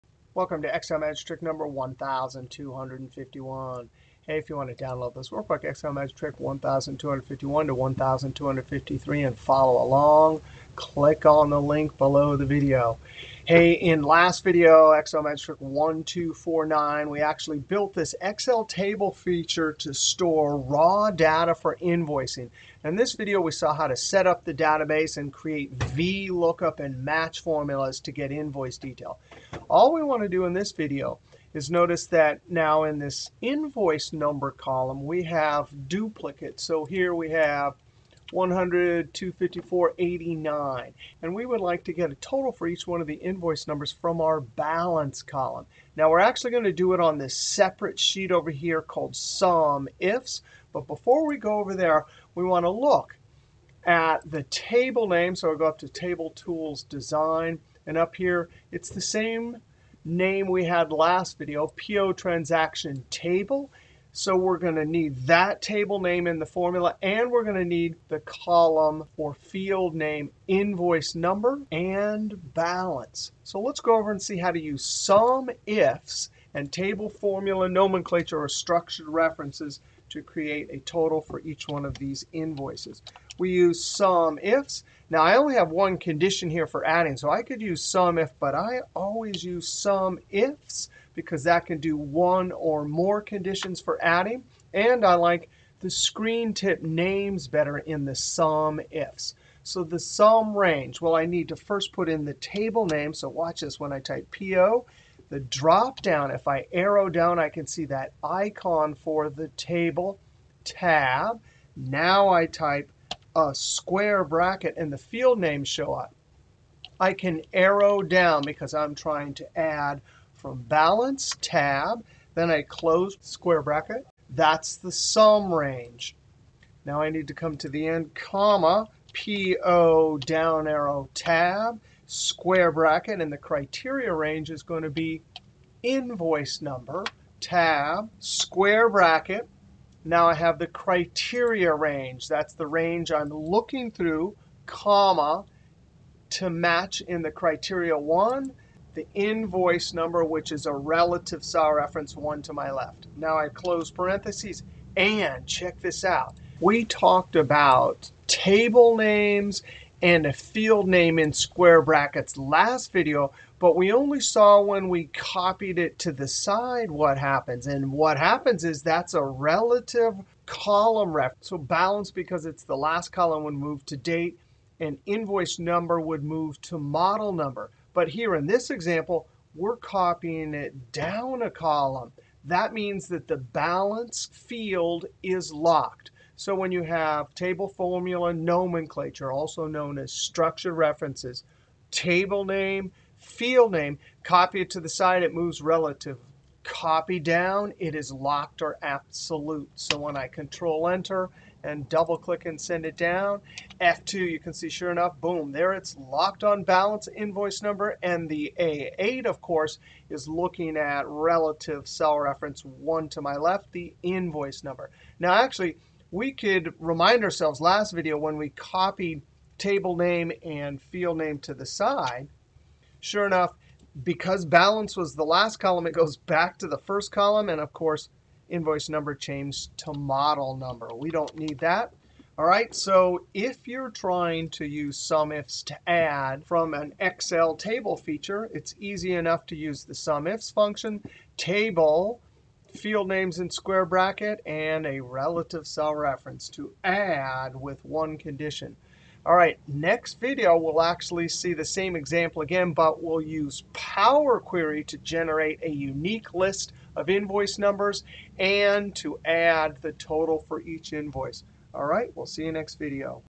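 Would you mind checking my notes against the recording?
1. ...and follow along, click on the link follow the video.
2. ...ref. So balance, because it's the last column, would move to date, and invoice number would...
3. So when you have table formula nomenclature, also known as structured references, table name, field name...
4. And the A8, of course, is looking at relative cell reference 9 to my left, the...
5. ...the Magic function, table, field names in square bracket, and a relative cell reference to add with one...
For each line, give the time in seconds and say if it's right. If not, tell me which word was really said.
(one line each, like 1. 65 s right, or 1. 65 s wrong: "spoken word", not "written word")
1. 9 s wrong: "below", not "follow"
2. 171 s right
3. 186 s right
4. 208 s wrong: "1", not "9"
5. 239 s wrong: "SUMIFs", not "Magic".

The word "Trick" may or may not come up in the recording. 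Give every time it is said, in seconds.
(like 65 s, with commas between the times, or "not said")
1 s, 6 s, 15 s.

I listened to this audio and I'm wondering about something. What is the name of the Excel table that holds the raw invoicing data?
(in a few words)
PO Transaction Table.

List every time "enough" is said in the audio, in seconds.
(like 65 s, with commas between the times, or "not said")
204 s, 223 s, 239 s.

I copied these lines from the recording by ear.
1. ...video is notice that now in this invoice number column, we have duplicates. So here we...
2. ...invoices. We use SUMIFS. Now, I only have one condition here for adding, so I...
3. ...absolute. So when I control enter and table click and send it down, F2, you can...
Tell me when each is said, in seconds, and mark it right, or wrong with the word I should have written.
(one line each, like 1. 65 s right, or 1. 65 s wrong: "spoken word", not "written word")
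1. 30 s right
2. 82 s right
3. 198 s wrong: "double", not "table".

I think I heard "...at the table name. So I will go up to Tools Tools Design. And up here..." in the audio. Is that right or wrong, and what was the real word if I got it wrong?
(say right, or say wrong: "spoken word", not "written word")
wrong: "Table", not "Tools".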